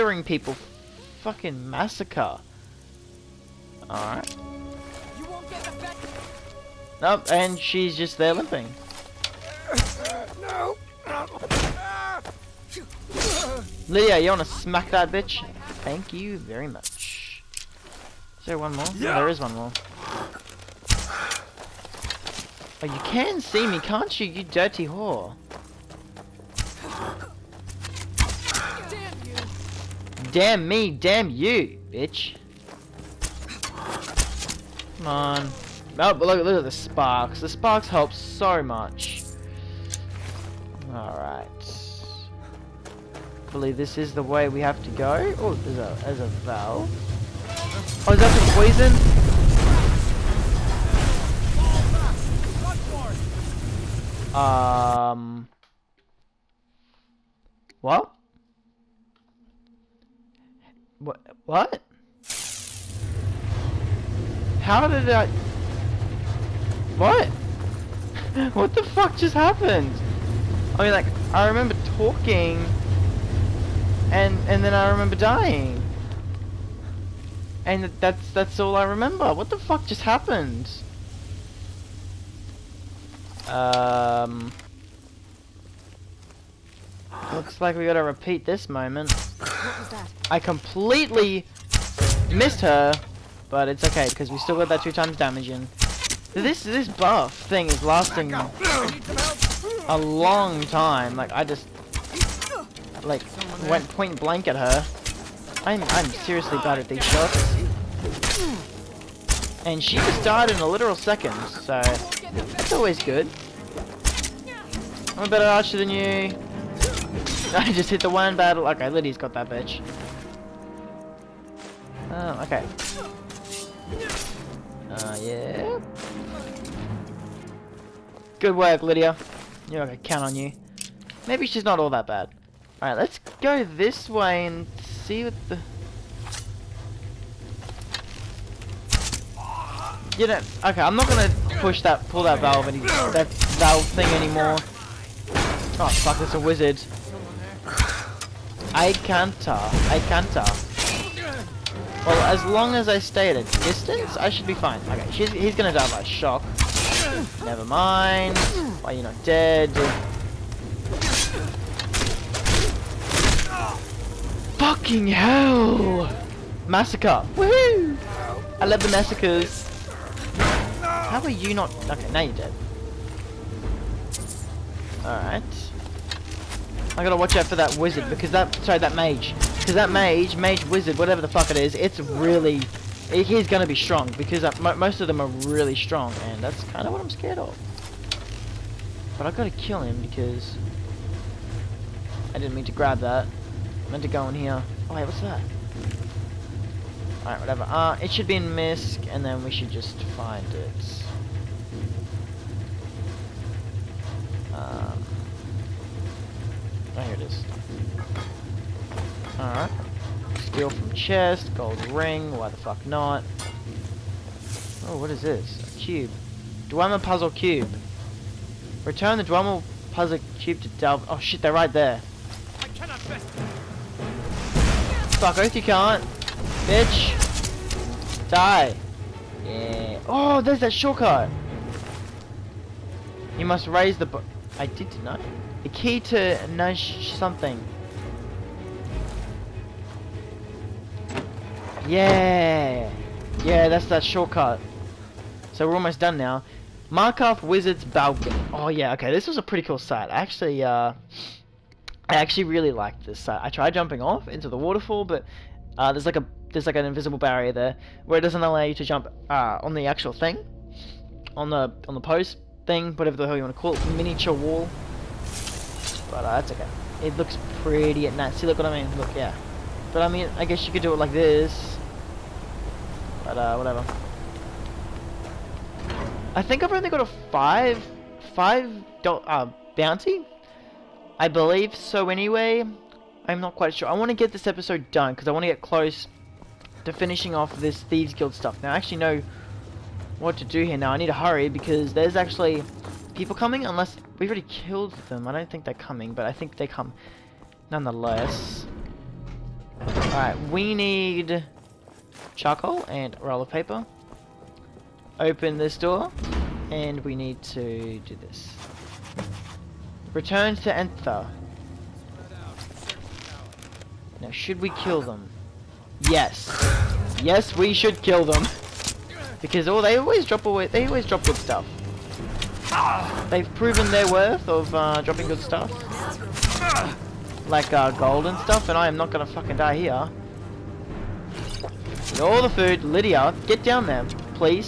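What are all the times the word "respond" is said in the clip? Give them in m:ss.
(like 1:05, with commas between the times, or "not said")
not said.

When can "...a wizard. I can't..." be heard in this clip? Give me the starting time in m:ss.
2:26.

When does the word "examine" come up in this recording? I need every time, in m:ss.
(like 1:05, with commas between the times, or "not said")
not said.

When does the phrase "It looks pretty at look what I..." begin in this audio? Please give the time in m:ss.
4:27.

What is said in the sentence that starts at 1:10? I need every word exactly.
I mean, like, I remember talking and and then I remember dying.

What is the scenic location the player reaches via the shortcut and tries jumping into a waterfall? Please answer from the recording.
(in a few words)
Markarth Wizard's Balcony.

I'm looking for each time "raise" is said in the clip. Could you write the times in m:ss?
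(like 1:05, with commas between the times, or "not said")
3:53.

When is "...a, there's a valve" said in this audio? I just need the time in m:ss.
0:45.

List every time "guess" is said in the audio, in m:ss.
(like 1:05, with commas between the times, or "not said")
4:30.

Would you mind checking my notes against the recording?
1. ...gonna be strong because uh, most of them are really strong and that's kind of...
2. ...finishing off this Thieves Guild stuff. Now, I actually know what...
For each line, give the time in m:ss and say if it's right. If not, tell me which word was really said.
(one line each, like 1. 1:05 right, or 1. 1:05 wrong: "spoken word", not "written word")
1. 3:03 right
2. 4:46 right.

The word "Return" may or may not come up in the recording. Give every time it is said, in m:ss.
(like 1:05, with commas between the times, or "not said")
3:38, 5:10.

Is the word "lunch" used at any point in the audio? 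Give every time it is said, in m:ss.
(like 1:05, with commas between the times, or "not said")
not said.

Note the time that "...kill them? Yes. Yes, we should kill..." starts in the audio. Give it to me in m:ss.
5:14.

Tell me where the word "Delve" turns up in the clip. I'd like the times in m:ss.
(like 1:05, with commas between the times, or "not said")
3:40.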